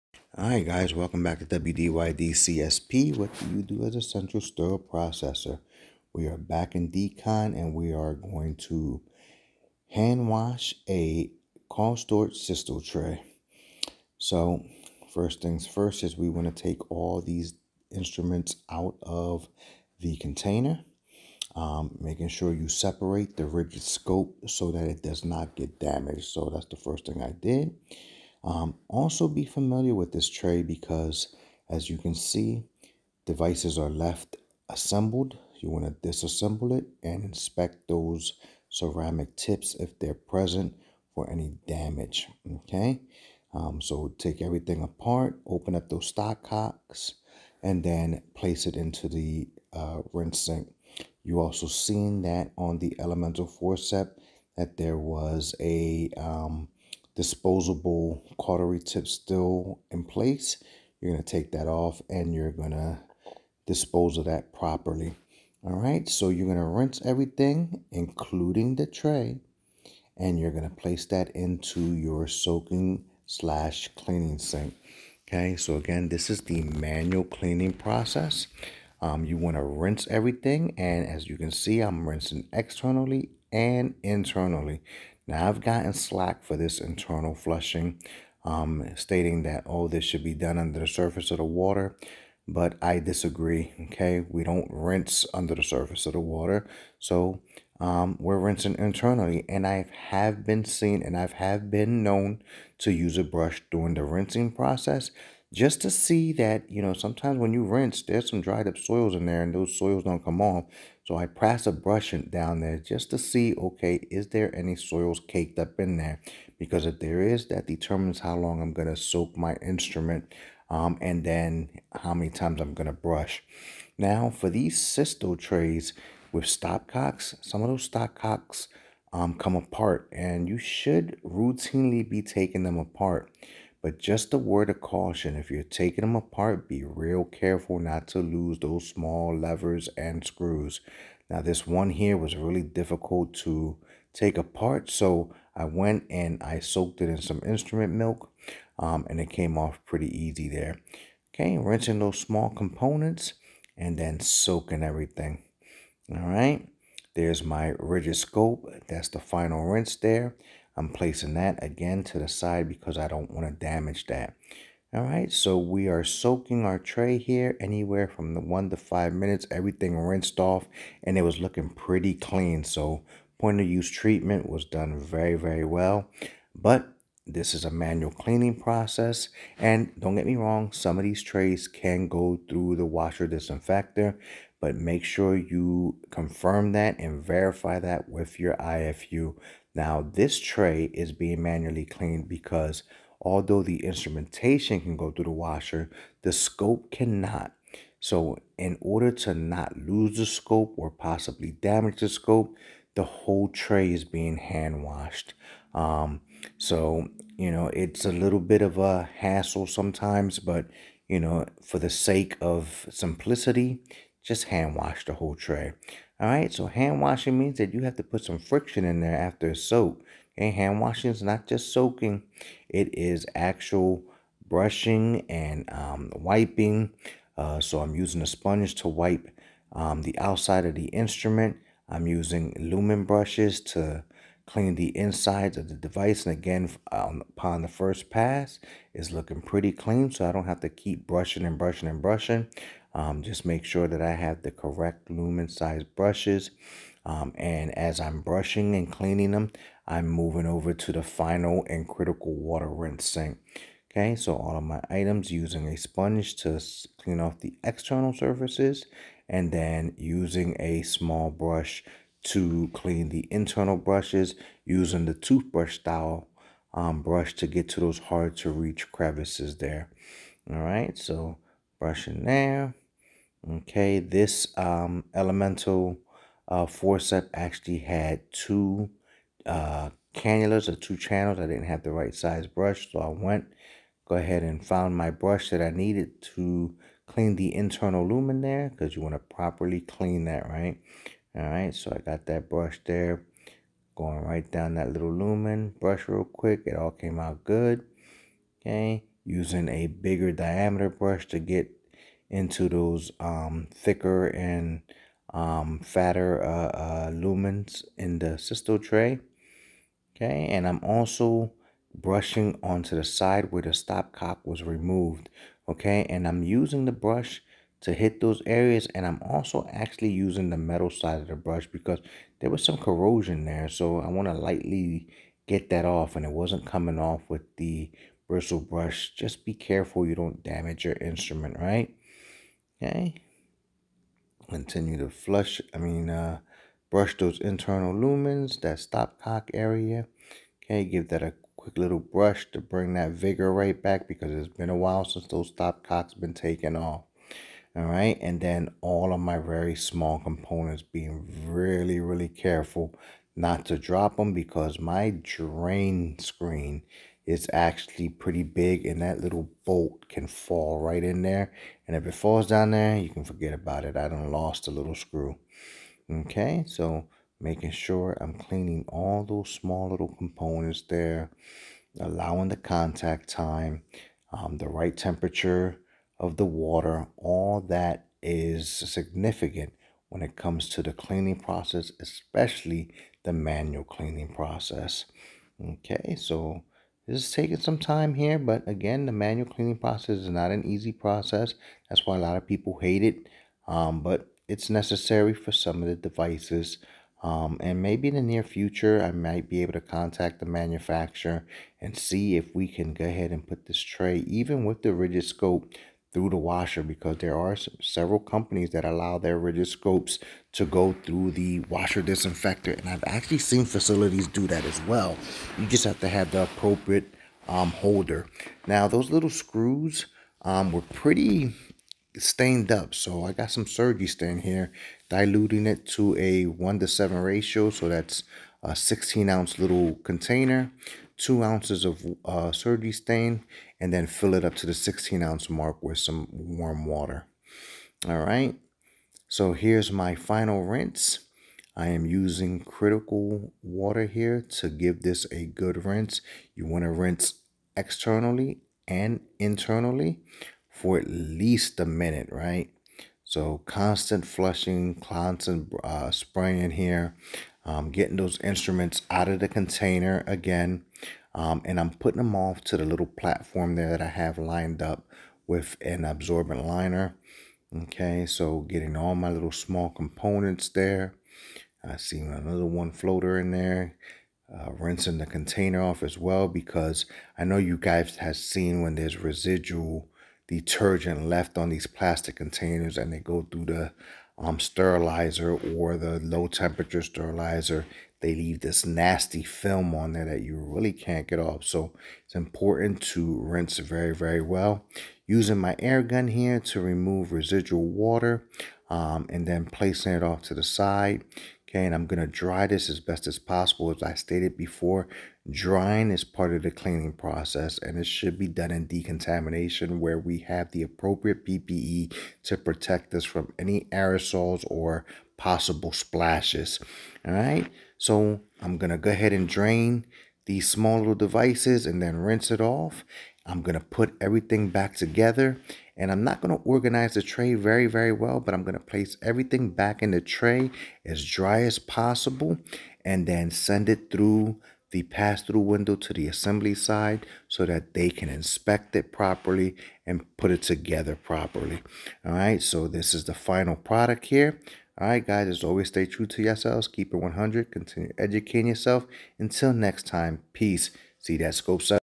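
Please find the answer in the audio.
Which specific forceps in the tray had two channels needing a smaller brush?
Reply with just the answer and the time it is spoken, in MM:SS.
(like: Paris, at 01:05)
elemental forceps, at 04:35.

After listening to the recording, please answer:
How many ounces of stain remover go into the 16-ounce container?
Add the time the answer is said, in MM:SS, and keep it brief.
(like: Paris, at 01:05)
2 ounces, at 07:11.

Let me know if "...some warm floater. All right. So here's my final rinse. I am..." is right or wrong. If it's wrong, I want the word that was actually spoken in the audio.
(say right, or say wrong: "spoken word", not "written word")
wrong: "water", not "floater".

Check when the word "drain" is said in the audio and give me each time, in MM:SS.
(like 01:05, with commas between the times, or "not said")
05:55, 08:39.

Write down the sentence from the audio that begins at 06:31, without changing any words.
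That's why a lot of people hate it, um, but it's necessary for some of the devices.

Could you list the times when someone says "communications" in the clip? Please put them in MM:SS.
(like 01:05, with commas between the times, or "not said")
not said.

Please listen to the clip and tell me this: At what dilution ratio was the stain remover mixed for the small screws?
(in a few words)
1 to 7.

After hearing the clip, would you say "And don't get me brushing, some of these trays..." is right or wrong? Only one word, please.
wrong.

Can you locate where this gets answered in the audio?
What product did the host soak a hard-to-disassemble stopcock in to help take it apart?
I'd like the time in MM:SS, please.
02:27.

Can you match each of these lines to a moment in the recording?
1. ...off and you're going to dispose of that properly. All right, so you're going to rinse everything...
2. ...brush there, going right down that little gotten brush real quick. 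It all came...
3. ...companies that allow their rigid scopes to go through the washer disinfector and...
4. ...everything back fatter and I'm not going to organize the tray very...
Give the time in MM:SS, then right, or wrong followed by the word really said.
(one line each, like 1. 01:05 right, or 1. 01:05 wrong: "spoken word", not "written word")
1. 01:01 right
2. 04:52 wrong: "lumen", not "gotten"
3. 06:48 right
4. 08:44 wrong: "together", not "fatter".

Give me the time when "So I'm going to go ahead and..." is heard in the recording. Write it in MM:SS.
08:38.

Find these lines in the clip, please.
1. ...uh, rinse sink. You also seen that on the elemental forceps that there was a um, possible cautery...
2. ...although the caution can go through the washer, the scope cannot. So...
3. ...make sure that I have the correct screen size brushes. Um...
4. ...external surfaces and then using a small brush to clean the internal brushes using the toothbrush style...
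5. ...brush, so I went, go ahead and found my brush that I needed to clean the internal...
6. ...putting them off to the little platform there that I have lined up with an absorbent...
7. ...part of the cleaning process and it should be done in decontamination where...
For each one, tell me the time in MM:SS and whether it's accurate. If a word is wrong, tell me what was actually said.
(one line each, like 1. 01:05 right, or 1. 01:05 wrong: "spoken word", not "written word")
1. 00:49 wrong: "disposable", not "possible"
2. 03:13 wrong: "instrumentation", not "caution"
3. 04:03 wrong: "lumen", not "screen"
4. 04:17 right
5. 04:42 right
6. 07:41 right
7. 08:26 right.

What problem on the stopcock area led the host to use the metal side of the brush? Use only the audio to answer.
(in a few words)
corrosion.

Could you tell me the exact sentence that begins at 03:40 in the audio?
Okay, hand washing is not just soaking, it is actual brushing and um, wiping.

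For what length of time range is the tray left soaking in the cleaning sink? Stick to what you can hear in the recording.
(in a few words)
1 to 5 minutes.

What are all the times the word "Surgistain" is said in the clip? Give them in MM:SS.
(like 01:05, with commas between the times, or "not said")
07:03, 07:12.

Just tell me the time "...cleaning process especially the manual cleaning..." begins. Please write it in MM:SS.
06:20.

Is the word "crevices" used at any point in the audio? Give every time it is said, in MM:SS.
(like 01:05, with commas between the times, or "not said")
04:28.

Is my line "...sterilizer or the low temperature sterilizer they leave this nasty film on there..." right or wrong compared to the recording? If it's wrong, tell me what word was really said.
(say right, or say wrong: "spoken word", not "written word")
right.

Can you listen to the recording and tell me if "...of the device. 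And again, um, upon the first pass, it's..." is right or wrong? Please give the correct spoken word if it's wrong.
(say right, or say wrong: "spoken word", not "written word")
right.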